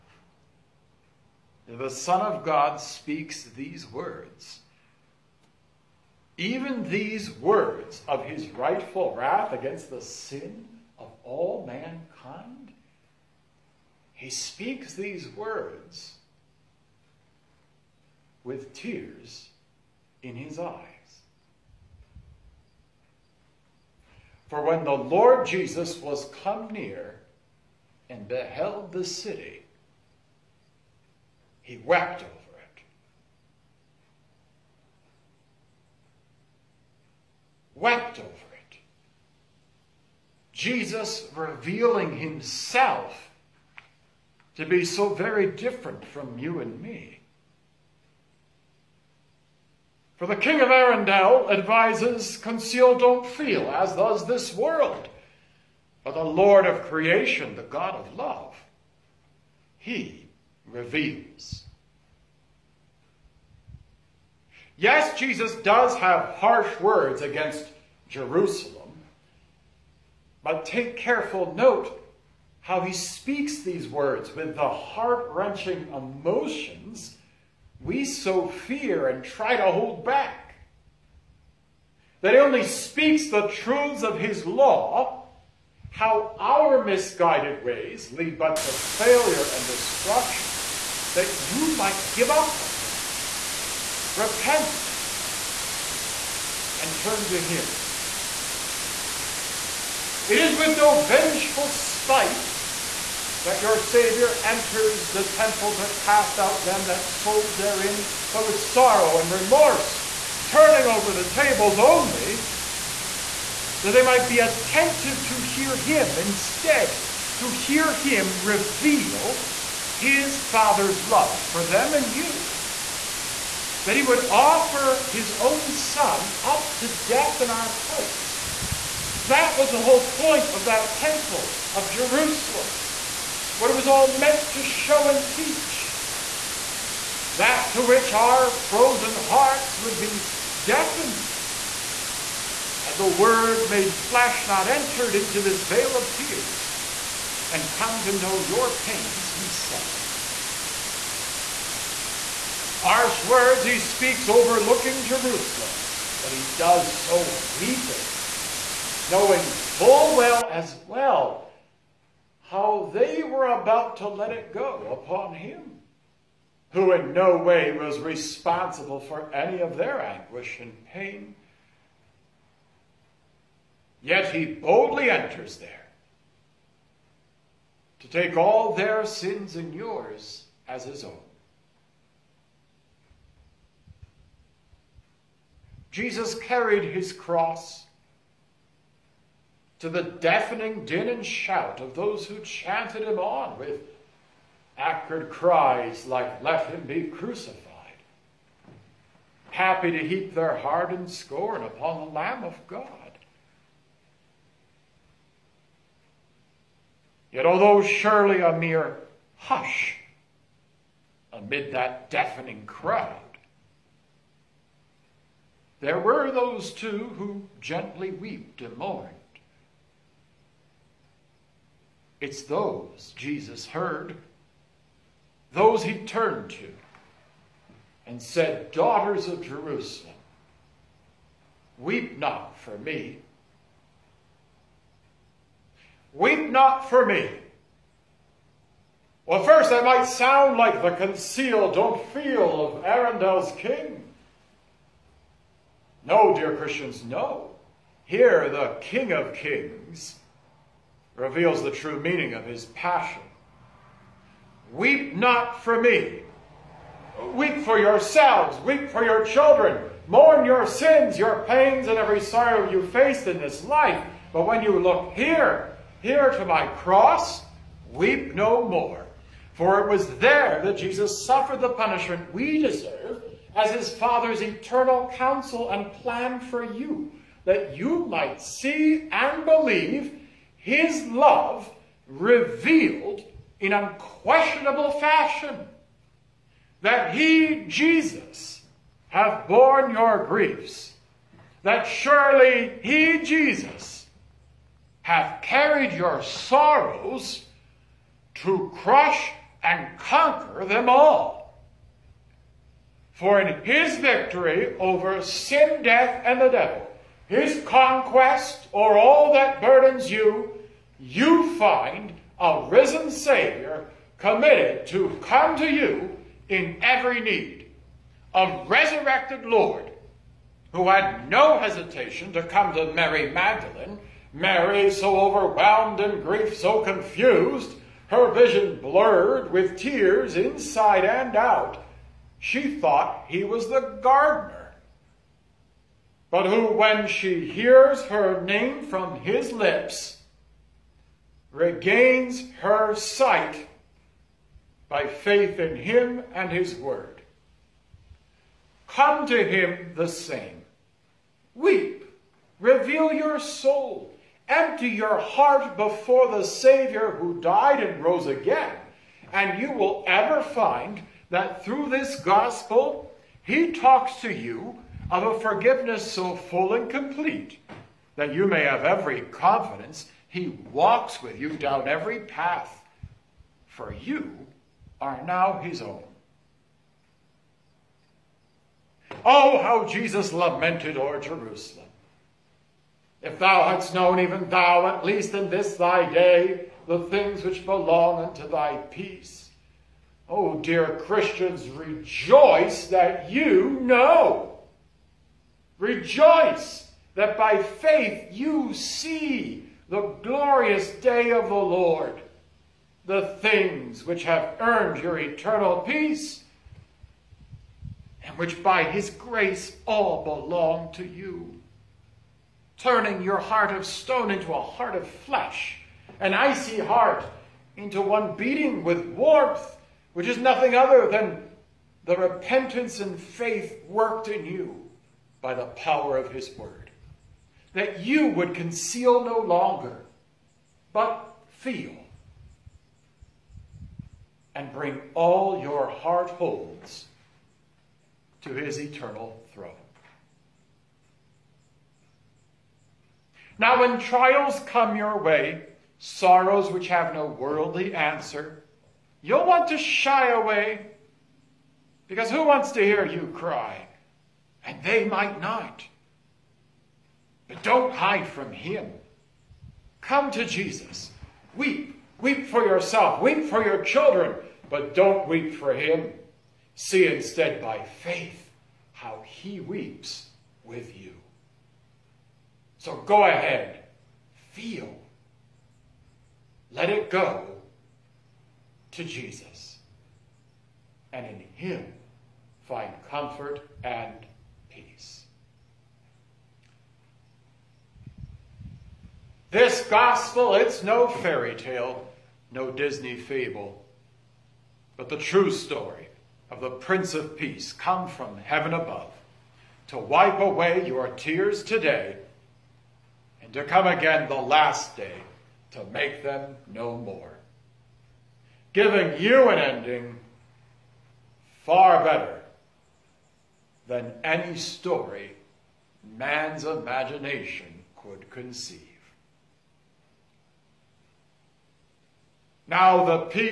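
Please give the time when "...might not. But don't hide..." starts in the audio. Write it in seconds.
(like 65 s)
455 s.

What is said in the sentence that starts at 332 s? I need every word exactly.
She thought he was the gardener.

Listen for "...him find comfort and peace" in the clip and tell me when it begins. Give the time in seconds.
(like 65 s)
481 s.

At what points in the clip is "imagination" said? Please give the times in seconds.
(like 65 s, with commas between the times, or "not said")
516 s.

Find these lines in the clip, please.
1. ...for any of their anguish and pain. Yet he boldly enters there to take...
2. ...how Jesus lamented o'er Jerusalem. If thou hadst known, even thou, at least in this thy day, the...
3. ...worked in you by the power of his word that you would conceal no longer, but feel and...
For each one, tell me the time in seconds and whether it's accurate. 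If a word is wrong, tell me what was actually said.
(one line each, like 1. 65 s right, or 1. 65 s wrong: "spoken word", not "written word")
1. 169 s right
2. 379 s right
3. 423 s right.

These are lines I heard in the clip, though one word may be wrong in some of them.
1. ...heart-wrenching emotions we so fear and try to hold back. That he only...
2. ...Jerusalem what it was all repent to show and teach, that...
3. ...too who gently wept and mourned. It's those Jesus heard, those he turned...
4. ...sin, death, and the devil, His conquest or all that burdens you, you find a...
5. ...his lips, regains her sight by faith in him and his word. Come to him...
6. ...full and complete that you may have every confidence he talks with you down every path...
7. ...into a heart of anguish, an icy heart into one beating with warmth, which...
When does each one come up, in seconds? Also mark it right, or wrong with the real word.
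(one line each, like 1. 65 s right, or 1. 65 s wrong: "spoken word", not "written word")
1. 74 s right
2. 131 s wrong: "meant", not "repent"
3. 216 s right
4. 305 s right
5. 339 s right
6. 366 s wrong: "walks", not "talks"
7. 414 s wrong: "flesh", not "anguish".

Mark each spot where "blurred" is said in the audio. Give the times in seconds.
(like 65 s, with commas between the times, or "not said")
328 s.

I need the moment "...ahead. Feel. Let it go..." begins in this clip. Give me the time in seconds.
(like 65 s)
473 s.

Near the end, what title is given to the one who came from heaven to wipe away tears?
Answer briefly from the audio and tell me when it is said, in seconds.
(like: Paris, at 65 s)
Prince of Peace, at 496 s.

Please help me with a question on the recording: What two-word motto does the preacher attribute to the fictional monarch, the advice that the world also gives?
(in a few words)
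conceal, don't feel.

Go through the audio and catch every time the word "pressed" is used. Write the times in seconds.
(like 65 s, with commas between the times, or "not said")
not said.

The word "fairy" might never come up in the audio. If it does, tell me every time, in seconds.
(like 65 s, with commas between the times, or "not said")
491 s.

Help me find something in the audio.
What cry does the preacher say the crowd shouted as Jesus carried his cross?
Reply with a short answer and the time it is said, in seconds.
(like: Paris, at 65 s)
Let him be crucified, at 196 s.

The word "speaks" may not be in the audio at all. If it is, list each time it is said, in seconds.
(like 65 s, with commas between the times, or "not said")
2 s, 14 s, 72 s, 82 s, 153 s.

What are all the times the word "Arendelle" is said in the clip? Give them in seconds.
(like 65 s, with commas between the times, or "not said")
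50 s, 242 s.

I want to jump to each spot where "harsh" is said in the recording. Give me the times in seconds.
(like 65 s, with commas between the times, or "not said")
66 s, 152 s.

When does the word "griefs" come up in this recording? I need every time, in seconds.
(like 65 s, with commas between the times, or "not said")
290 s, 326 s.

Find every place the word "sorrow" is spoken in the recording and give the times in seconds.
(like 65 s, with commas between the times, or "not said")
108 s, 262 s, 296 s, 446 s.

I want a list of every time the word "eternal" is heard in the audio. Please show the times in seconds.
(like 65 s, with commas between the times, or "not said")
274 s, 405 s, 438 s.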